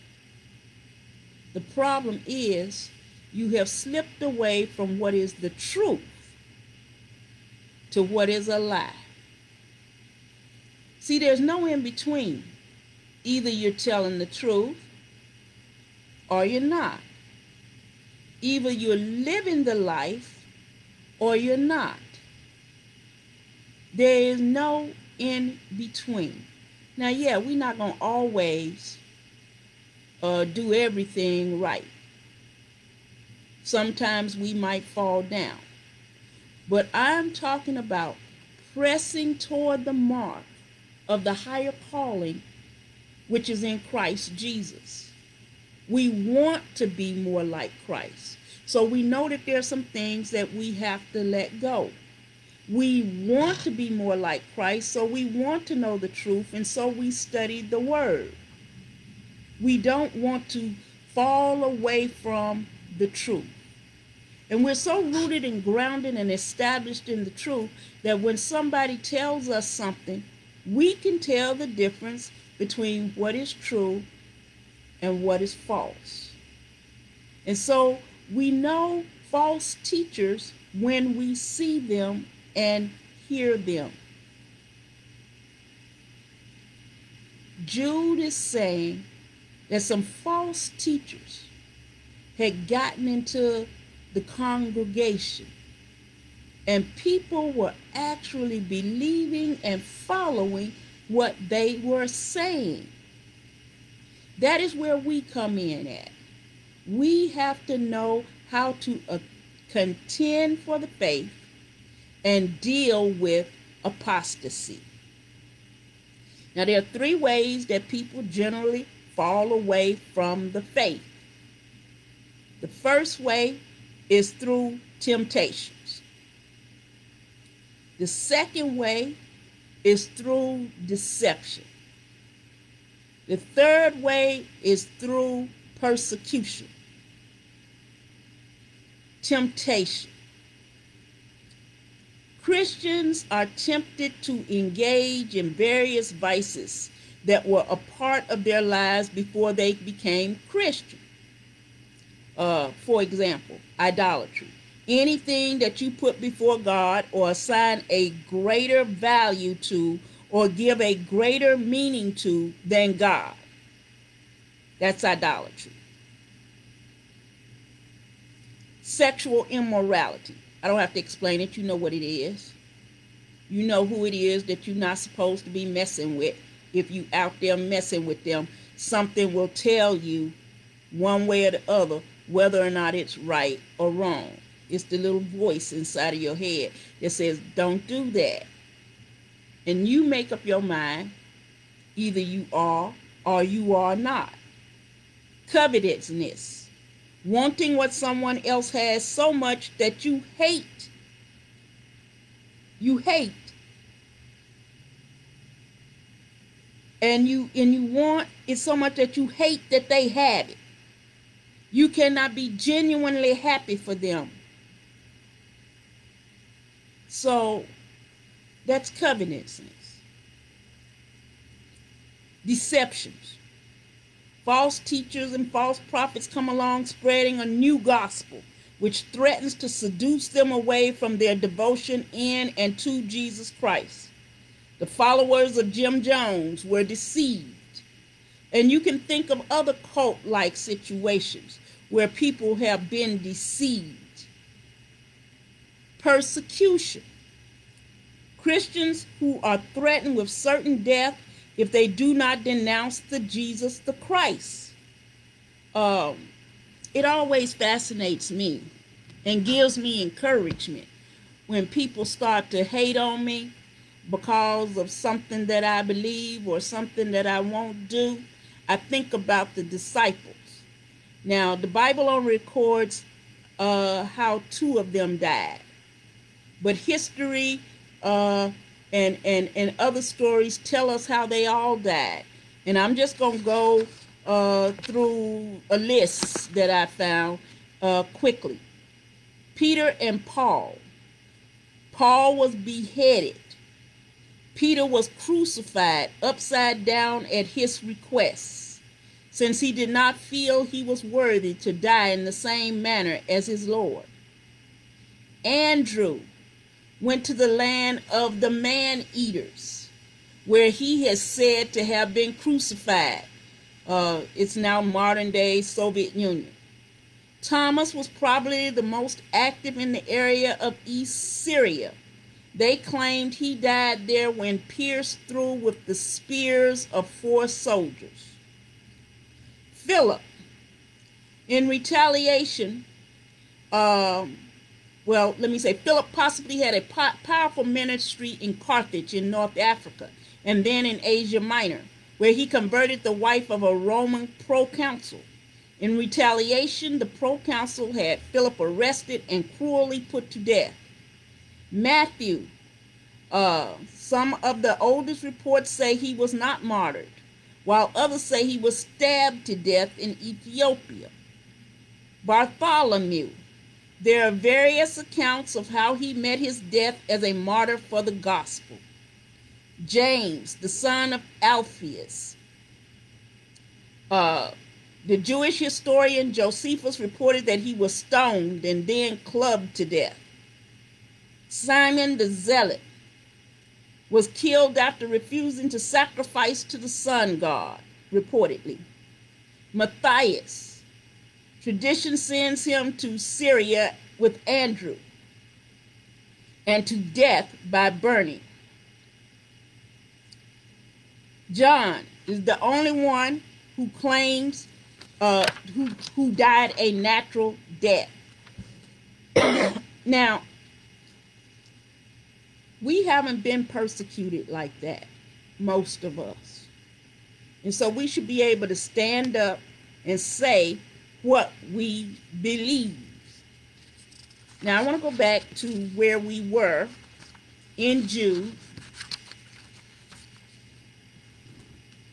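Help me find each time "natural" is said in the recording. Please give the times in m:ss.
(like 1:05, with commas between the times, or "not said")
6:46.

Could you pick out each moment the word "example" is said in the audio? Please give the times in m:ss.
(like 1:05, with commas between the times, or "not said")
2:33.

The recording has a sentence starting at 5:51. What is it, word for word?
Matthew, uh, some of the oldest reports say he was not martyred, while others say he was stabbed to death in Ethiopia.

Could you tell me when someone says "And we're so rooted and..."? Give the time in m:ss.
1:04.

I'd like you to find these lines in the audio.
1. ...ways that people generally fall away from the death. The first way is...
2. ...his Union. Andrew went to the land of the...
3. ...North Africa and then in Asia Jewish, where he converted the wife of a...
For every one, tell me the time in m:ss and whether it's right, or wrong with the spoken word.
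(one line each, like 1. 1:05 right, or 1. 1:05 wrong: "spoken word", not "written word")
1. 1:57 wrong: "faith", not "death"
2. 5:03 wrong: "Lord", not "Union"
3. 5:39 wrong: "Minor", not "Jewish".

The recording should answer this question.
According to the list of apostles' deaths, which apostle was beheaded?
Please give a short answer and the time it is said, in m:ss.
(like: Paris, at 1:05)
Paul, at 4:51.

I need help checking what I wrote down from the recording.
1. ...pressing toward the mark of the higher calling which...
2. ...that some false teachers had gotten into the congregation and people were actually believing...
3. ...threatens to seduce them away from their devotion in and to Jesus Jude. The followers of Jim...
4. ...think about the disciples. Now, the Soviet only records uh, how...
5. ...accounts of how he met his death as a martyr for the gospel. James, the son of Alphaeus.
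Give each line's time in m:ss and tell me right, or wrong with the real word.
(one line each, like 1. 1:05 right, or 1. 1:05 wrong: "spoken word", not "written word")
1. 0:38 right
2. 1:29 right
3. 3:49 wrong: "Christ", not "Jude"
4. 4:28 wrong: "Bible", not "Soviet"
5. 6:04 right.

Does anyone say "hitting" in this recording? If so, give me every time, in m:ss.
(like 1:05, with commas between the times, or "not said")
not said.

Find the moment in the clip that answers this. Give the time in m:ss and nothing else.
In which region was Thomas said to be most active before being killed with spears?
5:20.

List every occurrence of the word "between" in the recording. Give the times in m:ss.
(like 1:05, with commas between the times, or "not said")
0:11, 0:25, 1:12.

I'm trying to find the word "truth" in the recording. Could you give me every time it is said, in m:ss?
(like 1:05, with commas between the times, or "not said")
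0:05, 0:14, 0:56, 1:03, 1:07.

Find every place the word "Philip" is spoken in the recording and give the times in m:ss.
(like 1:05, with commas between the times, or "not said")
5:29, 5:35, 5:48.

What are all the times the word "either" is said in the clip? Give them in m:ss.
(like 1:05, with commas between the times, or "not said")
0:13, 0:18, 3:11.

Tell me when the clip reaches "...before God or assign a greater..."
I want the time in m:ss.
2:36.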